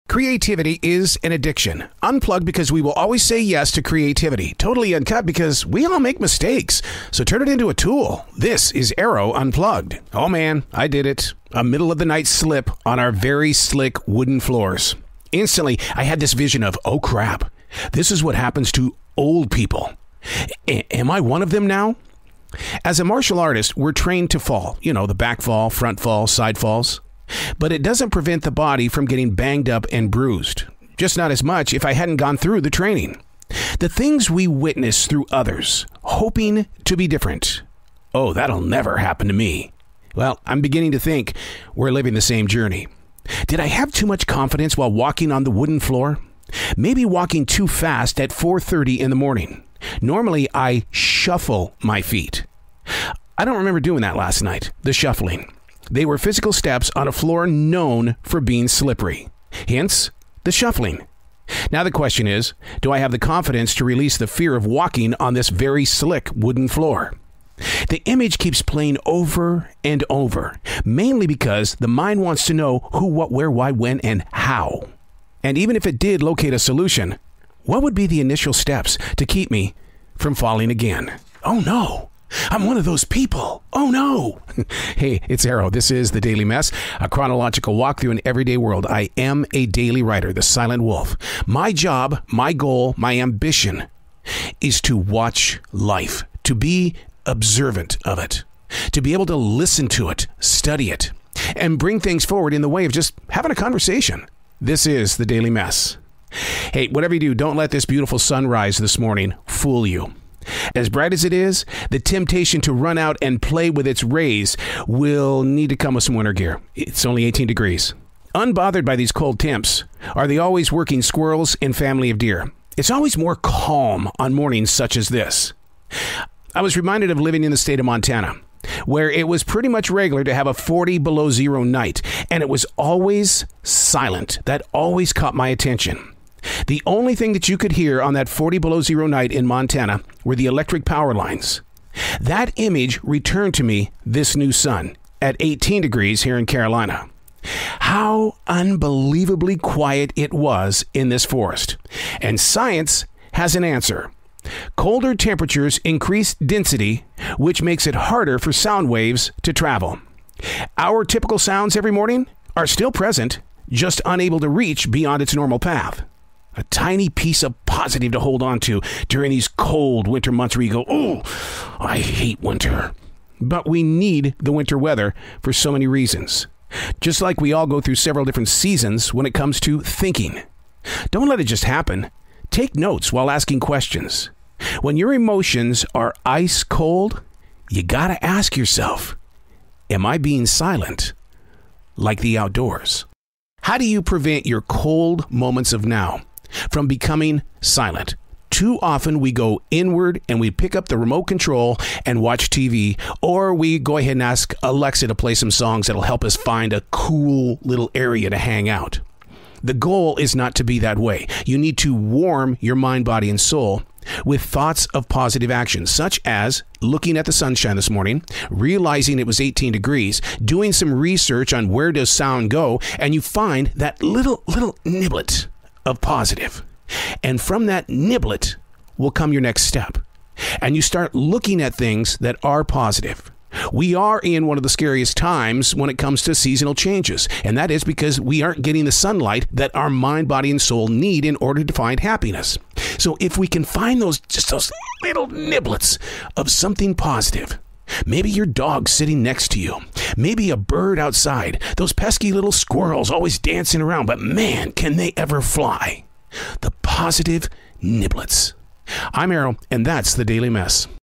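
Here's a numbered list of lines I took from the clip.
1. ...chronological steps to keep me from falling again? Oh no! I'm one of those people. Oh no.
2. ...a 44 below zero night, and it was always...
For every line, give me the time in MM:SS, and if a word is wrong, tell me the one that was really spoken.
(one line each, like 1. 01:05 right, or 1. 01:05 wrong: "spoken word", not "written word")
1. 01:18 wrong: "initial", not "chronological"
2. 02:10 wrong: "40", not "44".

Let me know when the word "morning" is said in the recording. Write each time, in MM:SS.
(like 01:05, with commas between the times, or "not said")
00:49, 01:48, 02:04, 02:41, 03:37.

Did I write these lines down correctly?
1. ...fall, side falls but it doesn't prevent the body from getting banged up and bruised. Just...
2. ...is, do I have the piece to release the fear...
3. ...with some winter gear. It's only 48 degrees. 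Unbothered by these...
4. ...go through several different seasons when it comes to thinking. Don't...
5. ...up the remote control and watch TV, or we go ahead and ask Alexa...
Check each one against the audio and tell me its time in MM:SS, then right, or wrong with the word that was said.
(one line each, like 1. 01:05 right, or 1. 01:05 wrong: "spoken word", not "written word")
1. 00:26 right
2. 01:02 wrong: "confidence", not "piece"
3. 01:55 wrong: "18", not "48"
4. 02:57 right
5. 03:20 right.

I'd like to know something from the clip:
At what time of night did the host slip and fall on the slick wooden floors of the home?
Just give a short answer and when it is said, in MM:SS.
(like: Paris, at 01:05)
4:30, at 00:48.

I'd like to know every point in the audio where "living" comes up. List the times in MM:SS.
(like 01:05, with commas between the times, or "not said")
00:41, 02:07.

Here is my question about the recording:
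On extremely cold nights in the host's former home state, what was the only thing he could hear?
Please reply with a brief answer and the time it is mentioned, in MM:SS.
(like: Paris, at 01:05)
electric power lines, at 02:20.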